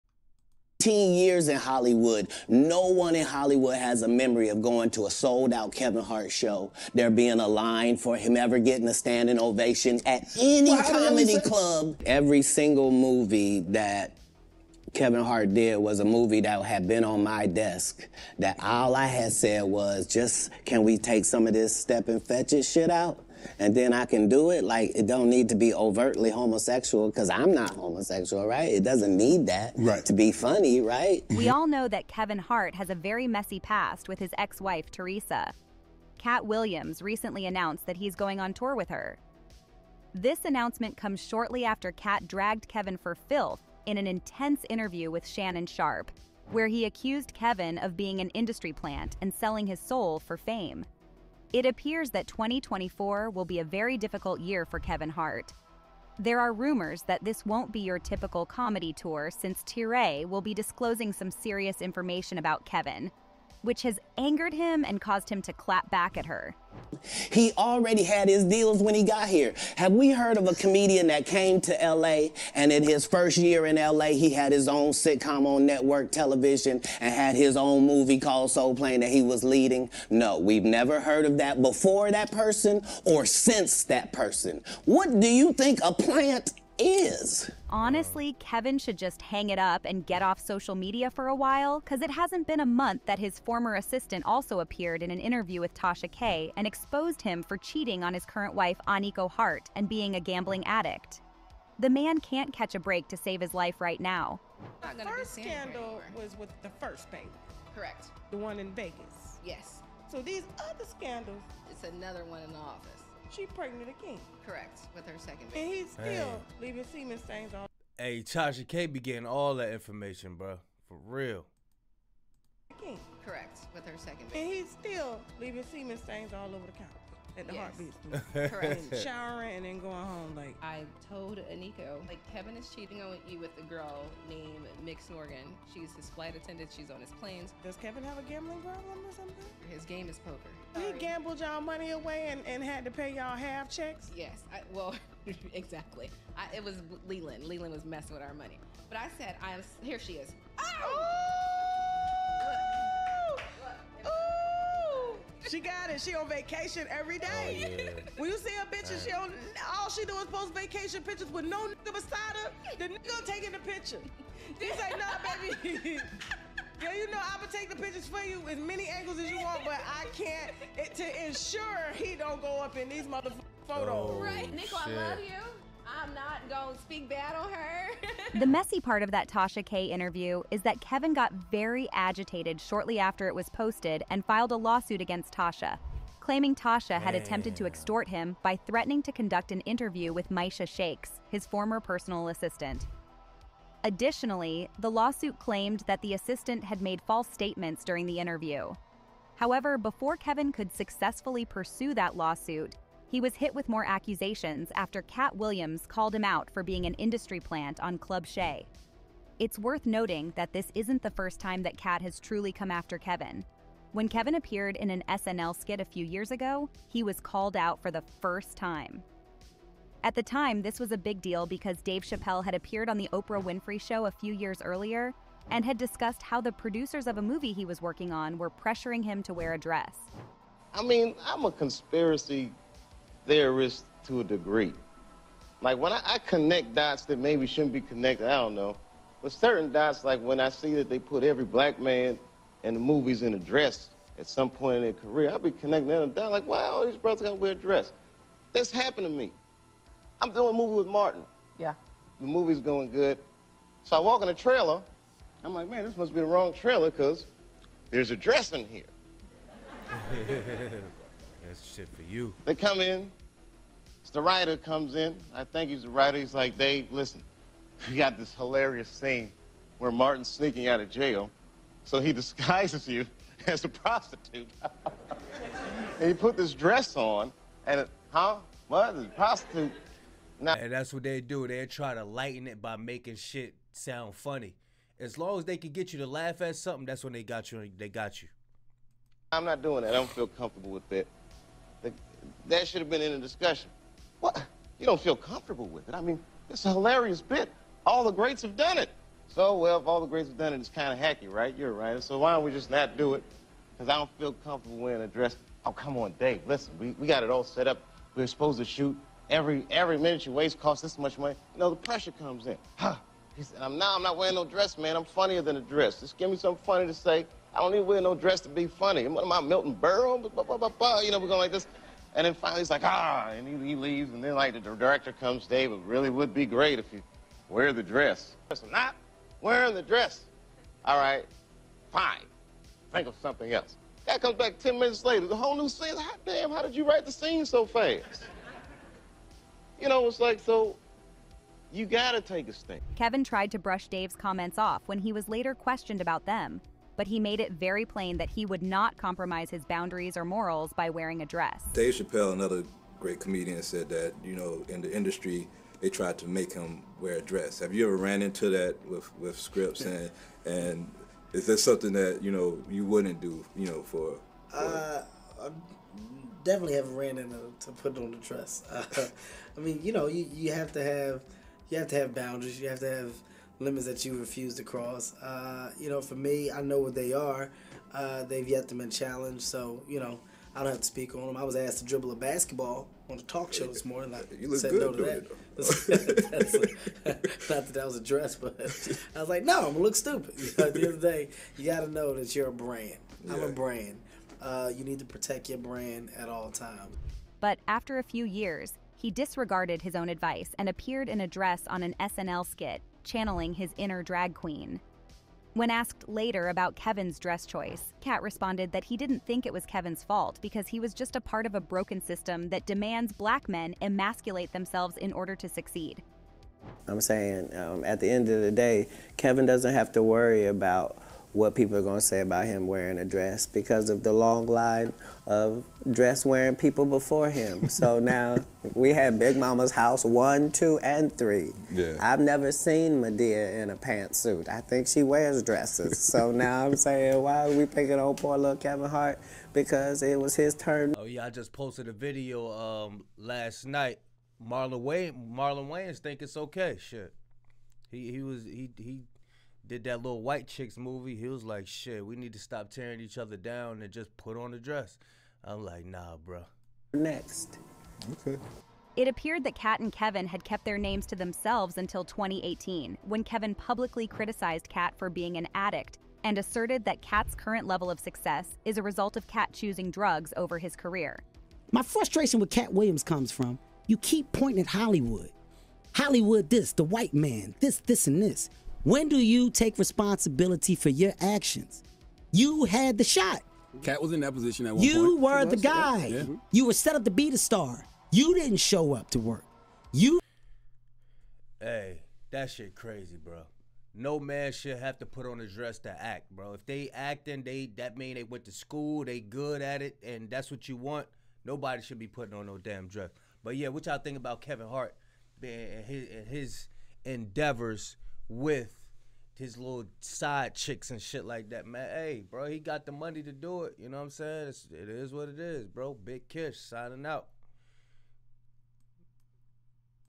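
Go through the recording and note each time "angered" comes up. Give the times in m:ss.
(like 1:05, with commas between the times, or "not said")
1:04.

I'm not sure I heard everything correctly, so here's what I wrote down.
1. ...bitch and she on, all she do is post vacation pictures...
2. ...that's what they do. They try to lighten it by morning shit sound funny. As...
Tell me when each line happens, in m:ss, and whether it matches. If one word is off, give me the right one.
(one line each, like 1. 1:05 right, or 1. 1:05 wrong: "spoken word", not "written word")
1. 2:38 right
2. 4:40 wrong: "making", not "morning".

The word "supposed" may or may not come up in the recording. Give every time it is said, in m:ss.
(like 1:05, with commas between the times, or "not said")
5:08.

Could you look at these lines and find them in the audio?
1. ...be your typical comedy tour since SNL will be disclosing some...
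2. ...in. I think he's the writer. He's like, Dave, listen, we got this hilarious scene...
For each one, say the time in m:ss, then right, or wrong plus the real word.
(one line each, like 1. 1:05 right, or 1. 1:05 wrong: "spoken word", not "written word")
1. 0:57 wrong: "Torrei", not "SNL"
2. 4:24 right.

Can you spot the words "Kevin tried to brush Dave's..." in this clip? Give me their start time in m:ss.
5:42.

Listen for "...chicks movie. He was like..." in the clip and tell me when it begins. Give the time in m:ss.
7:30.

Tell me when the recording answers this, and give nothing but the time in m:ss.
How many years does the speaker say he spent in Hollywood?
0:00.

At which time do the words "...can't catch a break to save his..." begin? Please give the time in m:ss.
1:42.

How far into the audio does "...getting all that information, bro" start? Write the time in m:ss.
1:58.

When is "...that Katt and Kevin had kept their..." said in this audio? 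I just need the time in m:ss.
7:39.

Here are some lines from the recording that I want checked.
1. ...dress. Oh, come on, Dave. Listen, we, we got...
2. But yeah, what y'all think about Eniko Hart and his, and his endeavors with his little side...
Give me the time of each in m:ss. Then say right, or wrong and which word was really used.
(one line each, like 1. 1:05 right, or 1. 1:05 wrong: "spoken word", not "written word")
1. 5:05 right
2. 8:23 wrong: "Kevin", not "Eniko".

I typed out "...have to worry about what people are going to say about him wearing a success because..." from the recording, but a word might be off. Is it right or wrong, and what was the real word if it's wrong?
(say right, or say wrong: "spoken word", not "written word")
wrong: "dress", not "success".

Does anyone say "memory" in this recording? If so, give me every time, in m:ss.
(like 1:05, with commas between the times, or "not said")
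0:04.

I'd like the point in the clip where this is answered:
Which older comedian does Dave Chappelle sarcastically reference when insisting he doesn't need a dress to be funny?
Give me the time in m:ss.
5:19.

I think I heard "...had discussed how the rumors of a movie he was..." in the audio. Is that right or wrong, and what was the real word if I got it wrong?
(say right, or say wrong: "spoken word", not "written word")
wrong: "producers", not "rumors".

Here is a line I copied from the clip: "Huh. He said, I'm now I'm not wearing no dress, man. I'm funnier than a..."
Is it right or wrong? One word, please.
right.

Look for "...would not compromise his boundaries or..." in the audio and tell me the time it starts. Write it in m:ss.
5:48.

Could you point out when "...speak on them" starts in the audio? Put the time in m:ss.
6:20.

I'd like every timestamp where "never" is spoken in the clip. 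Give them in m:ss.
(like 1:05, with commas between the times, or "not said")
1:20, 7:12.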